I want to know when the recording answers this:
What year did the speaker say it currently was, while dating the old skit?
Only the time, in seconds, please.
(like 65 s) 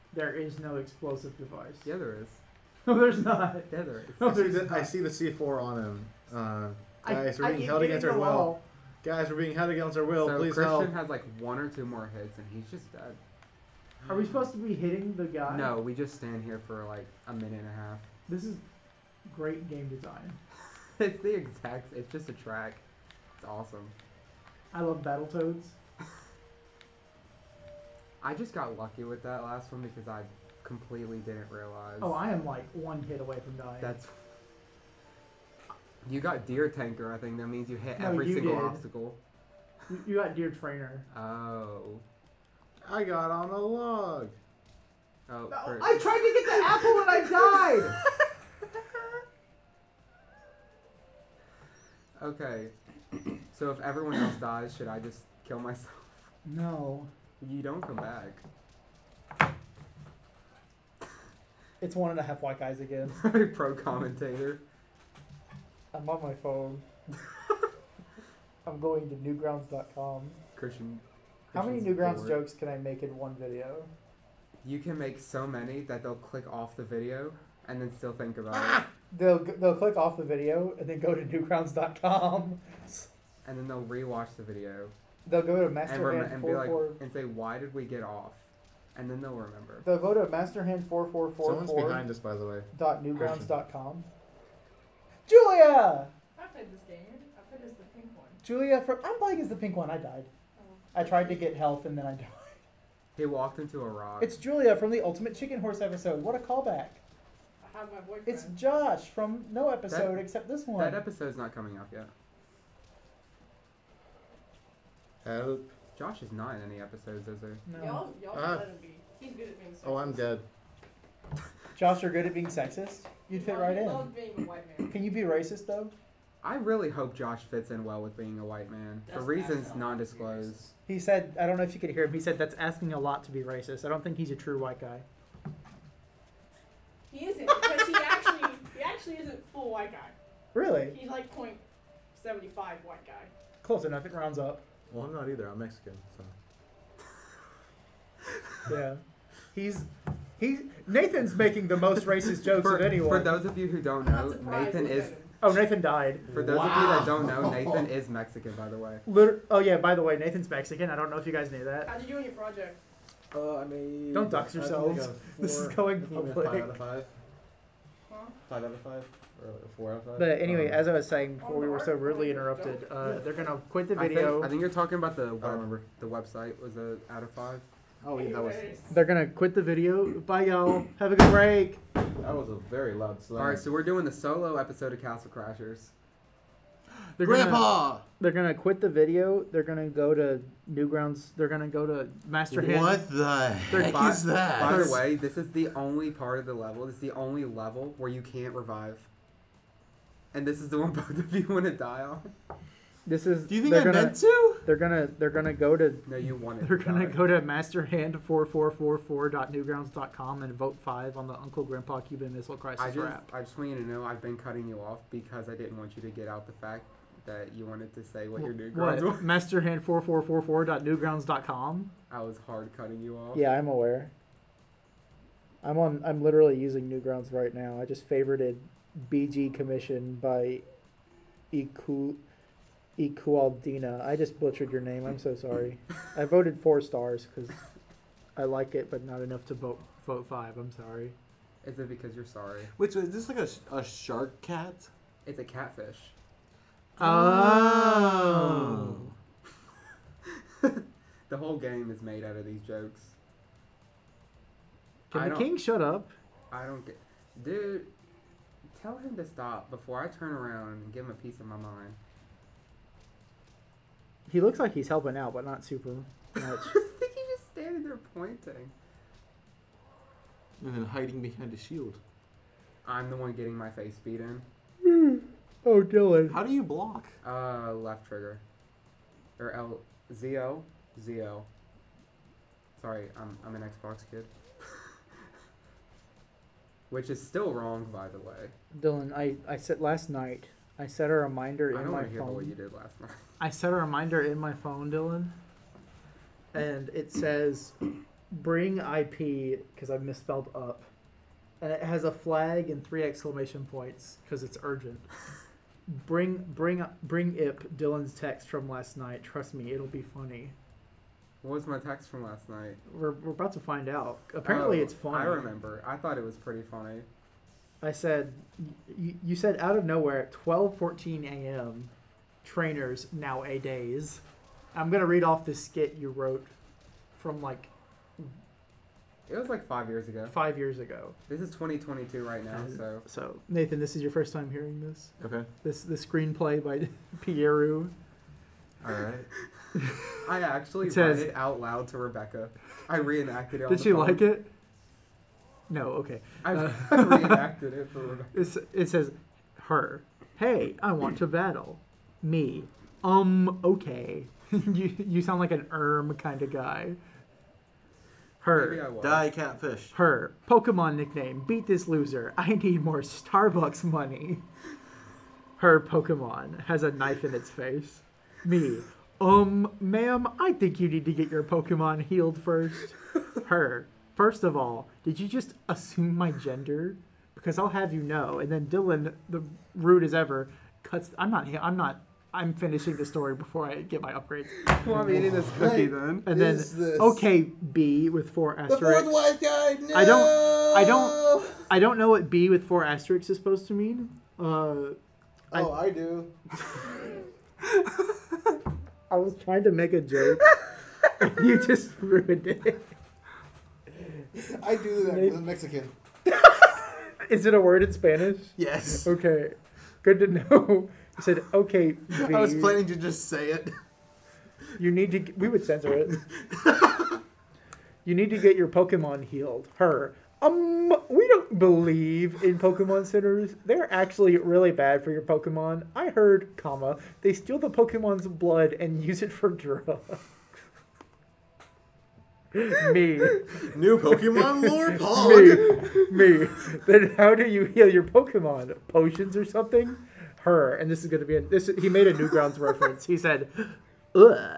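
331 s.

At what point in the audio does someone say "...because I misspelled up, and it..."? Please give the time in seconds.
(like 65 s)
299 s.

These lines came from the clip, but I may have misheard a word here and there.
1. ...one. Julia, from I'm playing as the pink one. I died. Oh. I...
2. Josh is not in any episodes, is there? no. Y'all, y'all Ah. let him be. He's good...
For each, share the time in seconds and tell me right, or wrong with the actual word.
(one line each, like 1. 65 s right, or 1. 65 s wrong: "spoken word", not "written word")
1. 98 s right
2. 115 s right.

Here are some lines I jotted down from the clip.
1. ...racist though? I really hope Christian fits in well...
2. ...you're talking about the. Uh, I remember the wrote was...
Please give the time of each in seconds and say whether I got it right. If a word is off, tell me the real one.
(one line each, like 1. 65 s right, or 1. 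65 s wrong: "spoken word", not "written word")
1. 125 s wrong: "Josh", not "Christian"
2. 174 s wrong: "website", not "wrote".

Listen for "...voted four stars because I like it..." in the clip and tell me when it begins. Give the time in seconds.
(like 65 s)
236 s.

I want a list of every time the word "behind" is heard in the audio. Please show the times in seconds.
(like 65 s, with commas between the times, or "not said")
91 s, 271 s.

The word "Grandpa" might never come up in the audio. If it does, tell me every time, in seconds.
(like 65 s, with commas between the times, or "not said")
187 s, 211 s.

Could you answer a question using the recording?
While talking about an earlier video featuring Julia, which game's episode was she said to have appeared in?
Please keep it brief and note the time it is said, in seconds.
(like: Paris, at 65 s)
Ultimate Chicken Horse, at 105 s.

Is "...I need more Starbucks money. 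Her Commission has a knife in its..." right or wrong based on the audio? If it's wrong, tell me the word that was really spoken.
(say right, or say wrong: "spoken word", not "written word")
wrong: "Pokemon", not "Commission".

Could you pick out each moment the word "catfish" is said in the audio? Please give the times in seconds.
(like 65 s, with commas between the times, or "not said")
245 s, 359 s.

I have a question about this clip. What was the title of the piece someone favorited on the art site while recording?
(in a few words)
BG Commission.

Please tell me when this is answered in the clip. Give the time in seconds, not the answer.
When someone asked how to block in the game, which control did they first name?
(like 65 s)
277 s.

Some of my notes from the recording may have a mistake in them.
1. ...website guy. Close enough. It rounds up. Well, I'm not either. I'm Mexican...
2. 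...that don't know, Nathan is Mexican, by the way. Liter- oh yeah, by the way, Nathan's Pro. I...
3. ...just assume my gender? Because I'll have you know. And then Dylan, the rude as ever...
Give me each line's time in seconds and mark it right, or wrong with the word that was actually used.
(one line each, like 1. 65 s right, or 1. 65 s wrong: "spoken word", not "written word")
1. 142 s wrong: "white", not "website"
2. 156 s wrong: "Mexican", not "Pro"
3. 375 s right.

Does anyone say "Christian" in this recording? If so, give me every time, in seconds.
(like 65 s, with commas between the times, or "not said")
10 s, 70 s.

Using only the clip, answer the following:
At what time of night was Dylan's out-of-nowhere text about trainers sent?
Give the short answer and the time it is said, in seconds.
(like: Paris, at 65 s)
12:14 a.m., at 320 s.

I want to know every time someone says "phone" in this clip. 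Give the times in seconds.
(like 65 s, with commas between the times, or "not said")
66 s, 294 s, 343 s.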